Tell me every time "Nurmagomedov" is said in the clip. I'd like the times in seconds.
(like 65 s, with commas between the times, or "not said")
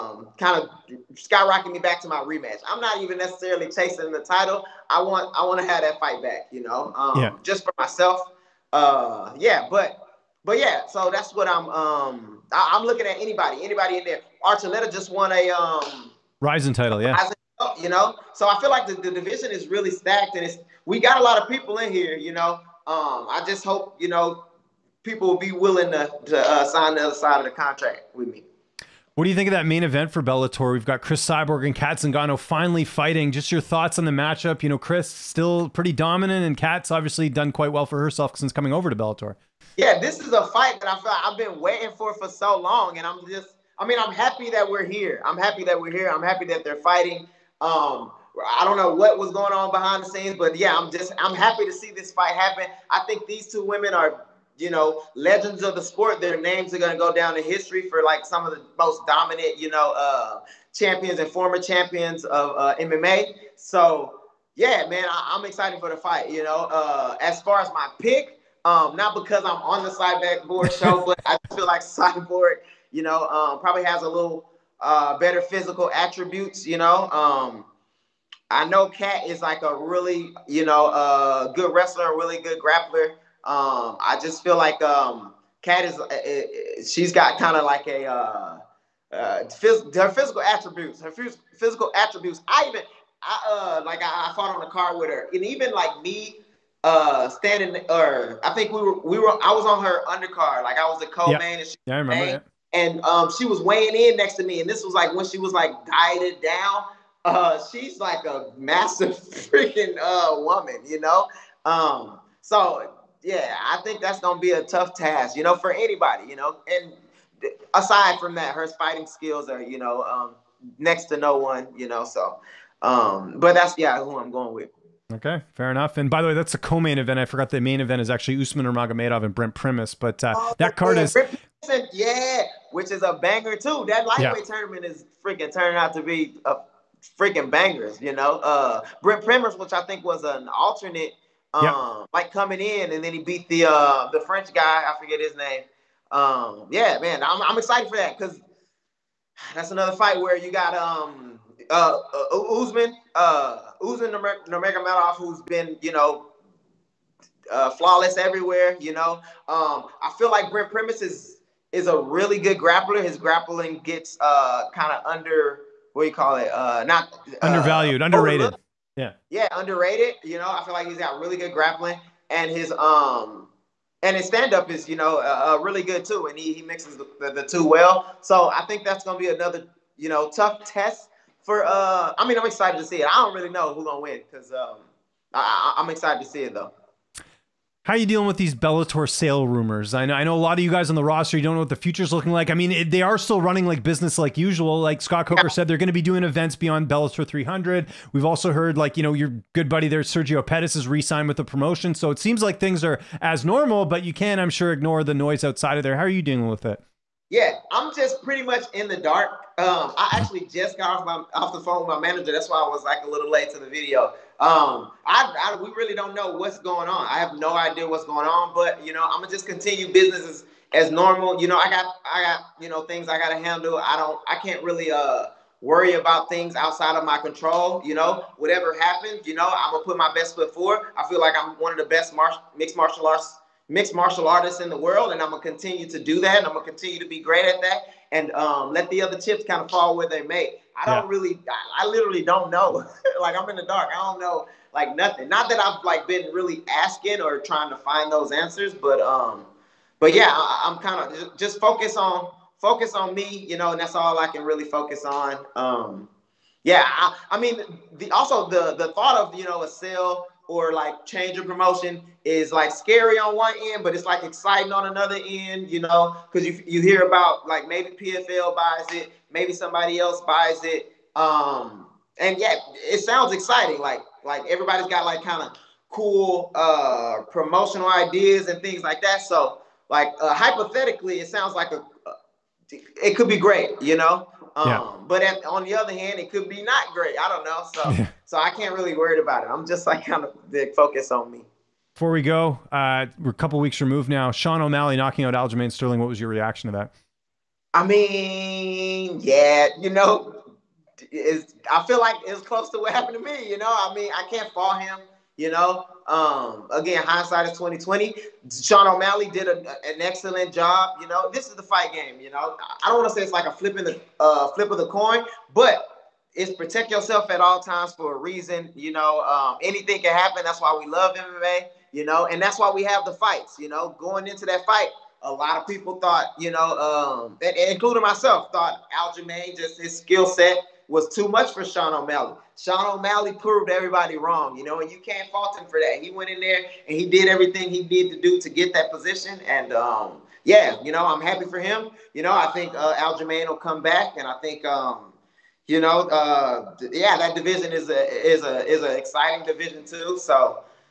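128 s, 154 s.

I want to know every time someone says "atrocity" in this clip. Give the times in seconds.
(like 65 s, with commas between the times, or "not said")
not said.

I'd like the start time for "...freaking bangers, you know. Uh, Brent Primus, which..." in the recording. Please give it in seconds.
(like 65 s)
137 s.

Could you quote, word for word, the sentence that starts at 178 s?
So I think that's gonna be another you know tough test for.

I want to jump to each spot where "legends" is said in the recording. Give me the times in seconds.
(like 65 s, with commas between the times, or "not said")
55 s.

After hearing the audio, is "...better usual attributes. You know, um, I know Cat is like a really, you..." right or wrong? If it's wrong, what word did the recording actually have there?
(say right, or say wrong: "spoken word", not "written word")
wrong: "physical", not "usual".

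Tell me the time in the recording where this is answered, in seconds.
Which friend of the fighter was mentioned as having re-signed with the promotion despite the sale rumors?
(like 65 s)
199 s.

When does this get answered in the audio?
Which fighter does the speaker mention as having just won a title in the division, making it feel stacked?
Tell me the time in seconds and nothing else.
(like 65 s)
14 s.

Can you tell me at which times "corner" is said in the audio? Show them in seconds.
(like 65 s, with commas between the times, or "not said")
not said.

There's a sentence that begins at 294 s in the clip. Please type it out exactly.
Sean O'Malley knocking out Aljamain Sterling.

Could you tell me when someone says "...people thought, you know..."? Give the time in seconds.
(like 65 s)
325 s.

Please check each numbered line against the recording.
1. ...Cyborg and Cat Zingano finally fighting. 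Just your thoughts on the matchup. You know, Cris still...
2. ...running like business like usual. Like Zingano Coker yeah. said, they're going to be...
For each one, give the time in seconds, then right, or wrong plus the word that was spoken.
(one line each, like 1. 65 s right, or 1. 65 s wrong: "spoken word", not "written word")
1. 31 s right
2. 193 s wrong: "Scott", not "Zingano".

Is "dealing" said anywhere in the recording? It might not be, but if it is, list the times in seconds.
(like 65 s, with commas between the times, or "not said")
188 s, 206 s.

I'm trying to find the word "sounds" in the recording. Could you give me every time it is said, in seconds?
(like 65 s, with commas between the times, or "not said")
272 s, 281 s.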